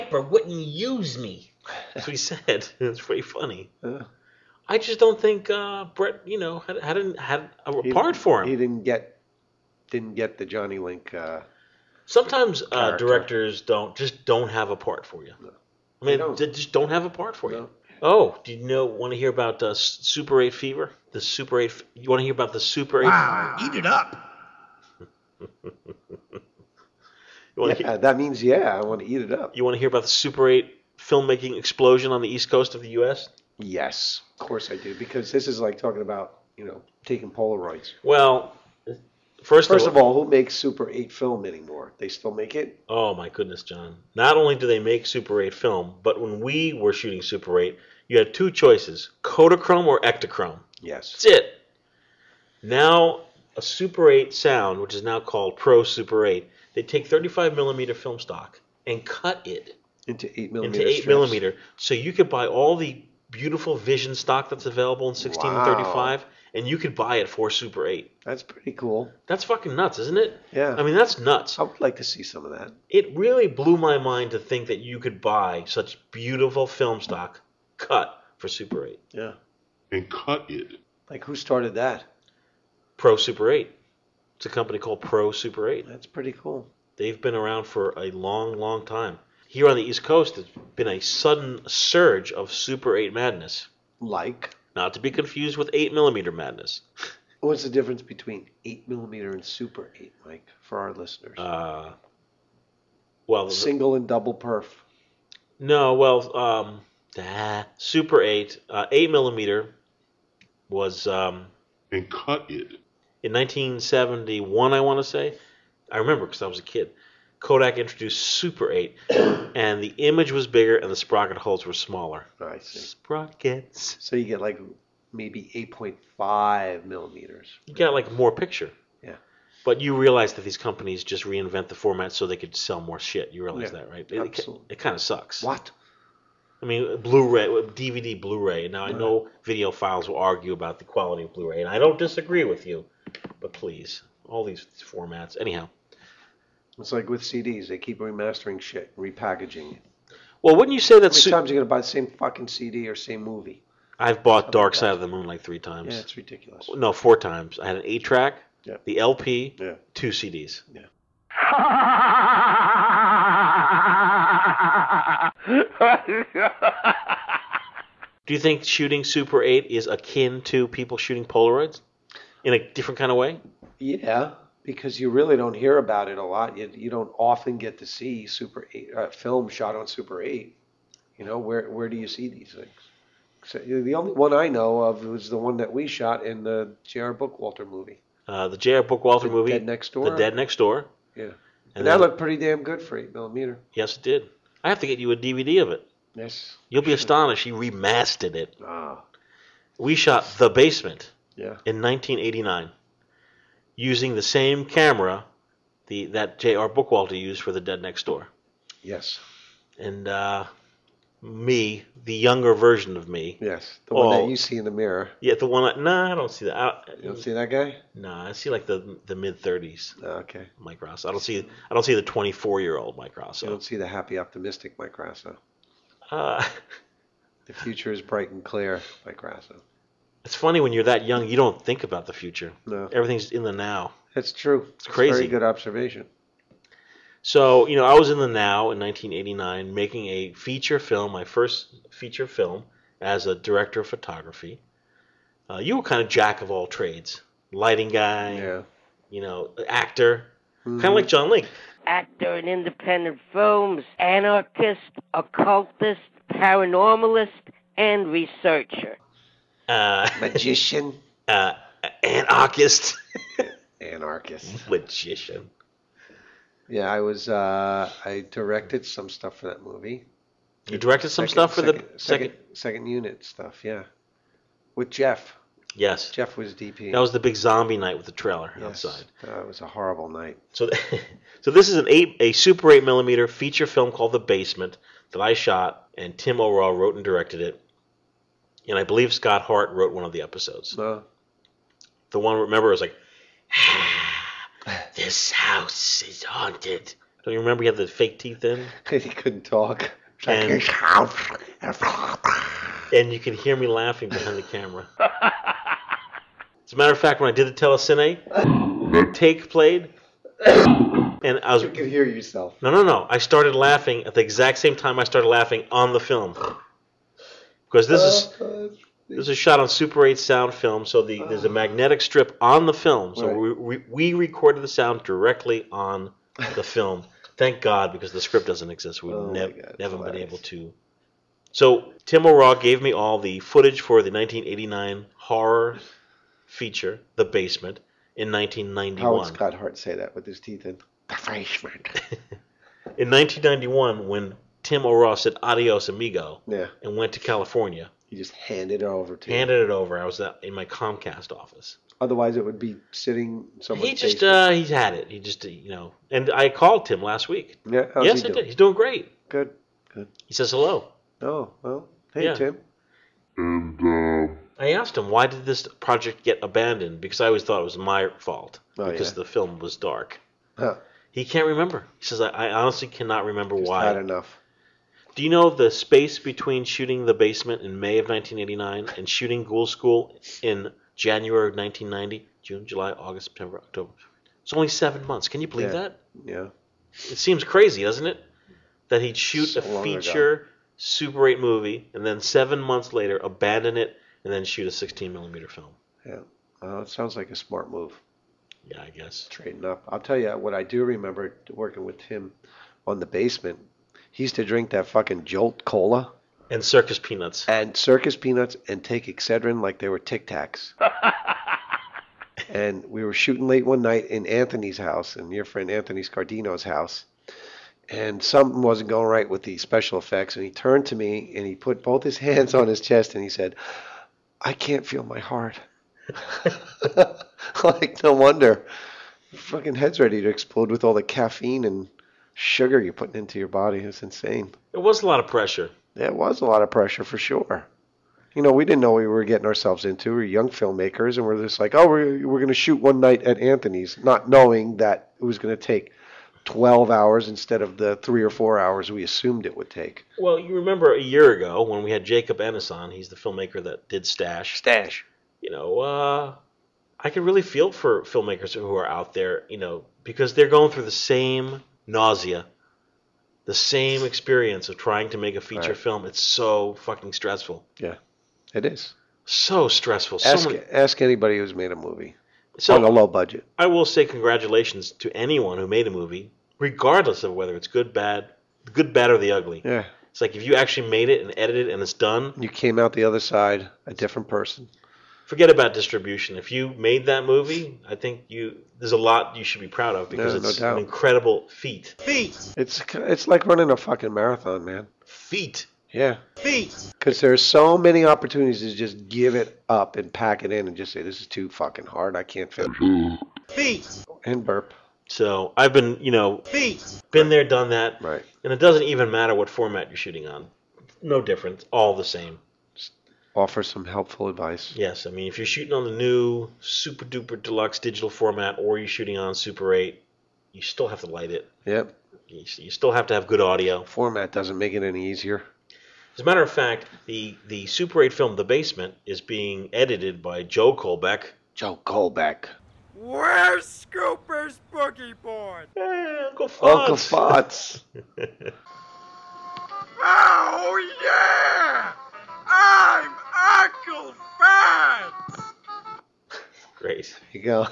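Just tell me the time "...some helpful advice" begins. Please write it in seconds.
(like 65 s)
513 s.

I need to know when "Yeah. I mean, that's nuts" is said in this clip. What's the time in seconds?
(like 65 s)
70 s.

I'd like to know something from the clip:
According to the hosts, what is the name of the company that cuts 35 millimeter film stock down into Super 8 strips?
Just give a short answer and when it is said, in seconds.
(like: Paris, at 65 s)
Pro Super 8, at 84 s.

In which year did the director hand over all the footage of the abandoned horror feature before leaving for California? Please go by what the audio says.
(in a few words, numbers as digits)
1991.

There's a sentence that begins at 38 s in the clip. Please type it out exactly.
Well, first, first of, all, of all, who makes Super 8 film anymore?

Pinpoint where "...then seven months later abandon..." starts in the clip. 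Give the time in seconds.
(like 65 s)
392 s.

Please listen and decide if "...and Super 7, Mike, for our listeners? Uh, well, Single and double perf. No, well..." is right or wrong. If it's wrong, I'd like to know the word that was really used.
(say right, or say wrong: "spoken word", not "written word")
wrong: "8", not "7".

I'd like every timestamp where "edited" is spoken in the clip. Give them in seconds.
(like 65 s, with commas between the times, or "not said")
481 s, 529 s.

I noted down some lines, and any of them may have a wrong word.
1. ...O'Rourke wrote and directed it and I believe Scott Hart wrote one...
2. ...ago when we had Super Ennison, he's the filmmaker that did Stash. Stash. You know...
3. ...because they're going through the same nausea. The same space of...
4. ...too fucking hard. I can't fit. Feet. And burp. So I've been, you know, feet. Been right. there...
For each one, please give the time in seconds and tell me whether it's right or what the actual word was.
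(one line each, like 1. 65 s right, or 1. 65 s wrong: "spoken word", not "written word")
1. 286 s right
2. 451 s wrong: "Jacob", not "Super"
3. 460 s wrong: "experience", not "space"
4. 501 s right.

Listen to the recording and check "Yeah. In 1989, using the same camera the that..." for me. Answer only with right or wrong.
right.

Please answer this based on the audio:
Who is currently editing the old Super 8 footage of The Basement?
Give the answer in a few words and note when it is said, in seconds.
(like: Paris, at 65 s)
Joe Colbeck, at 529 s.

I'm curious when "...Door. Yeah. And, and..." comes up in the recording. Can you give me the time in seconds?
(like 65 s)
190 s.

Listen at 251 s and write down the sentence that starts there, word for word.
Actor in independent films, anarchist, occultist, paranormalist, and researcher.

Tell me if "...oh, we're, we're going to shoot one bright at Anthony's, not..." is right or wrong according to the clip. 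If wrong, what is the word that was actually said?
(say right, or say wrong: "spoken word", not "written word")
wrong: "night", not "bright".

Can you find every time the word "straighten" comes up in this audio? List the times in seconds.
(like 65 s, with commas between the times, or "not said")
399 s.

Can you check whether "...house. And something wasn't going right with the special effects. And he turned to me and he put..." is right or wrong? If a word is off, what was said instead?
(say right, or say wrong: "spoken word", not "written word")
right.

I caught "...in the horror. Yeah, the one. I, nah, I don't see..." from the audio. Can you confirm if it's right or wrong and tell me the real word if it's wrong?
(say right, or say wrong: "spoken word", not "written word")
wrong: "mirror", not "horror".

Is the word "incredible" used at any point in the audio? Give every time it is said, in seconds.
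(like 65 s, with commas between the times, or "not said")
490 s.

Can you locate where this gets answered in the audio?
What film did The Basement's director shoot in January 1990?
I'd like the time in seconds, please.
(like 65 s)
379 s.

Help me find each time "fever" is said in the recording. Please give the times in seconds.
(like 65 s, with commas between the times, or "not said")
20 s.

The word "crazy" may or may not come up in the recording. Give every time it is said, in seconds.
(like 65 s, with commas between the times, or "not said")
234 s, 387 s.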